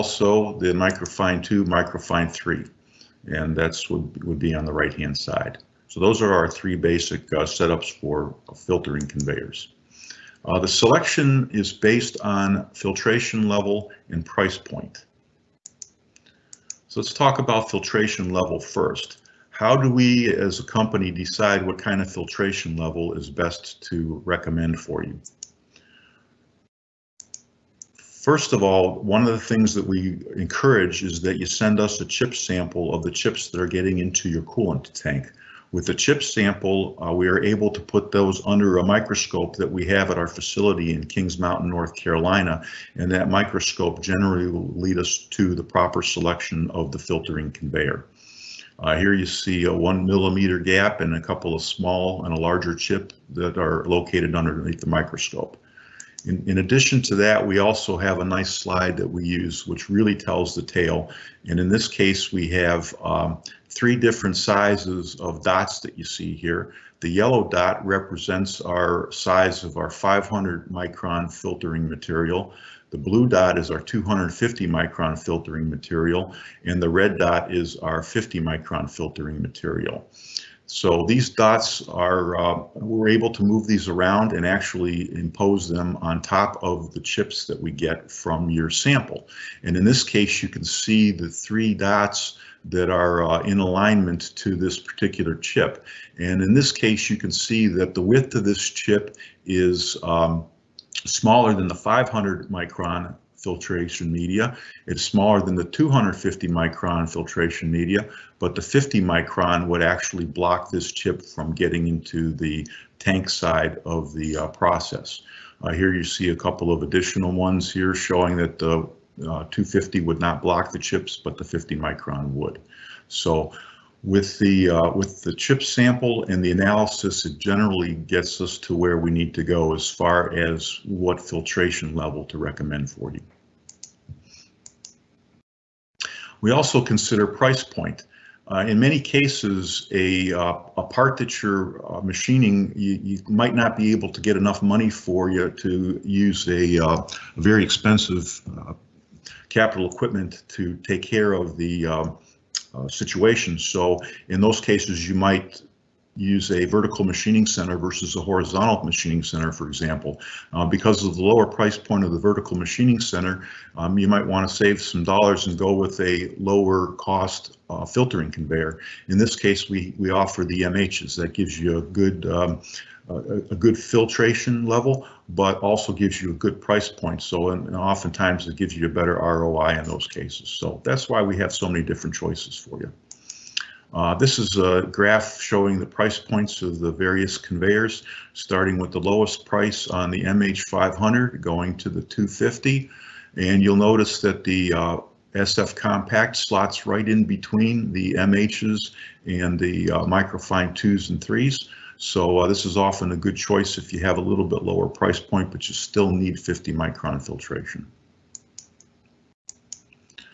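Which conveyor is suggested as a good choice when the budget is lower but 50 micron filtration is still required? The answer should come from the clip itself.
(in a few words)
SF Compact.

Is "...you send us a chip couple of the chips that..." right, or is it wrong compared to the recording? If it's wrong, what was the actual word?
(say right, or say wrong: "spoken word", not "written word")
wrong: "sample", not "couple".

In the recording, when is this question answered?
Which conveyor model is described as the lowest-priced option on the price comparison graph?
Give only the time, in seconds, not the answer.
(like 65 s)
190 s.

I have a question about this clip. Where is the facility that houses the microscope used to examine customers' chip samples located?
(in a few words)
Kings Mountain, North Carolina.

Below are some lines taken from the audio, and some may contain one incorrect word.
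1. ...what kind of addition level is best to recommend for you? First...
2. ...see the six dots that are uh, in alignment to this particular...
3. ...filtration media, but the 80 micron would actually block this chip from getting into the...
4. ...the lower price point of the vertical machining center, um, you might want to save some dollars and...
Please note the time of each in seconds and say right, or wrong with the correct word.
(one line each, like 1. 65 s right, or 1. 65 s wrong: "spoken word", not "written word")
1. 21 s wrong: "filtration", not "addition"
2. 90 s wrong: "three", not "six"
3. 107 s wrong: "50", not "80"
4. 161 s right.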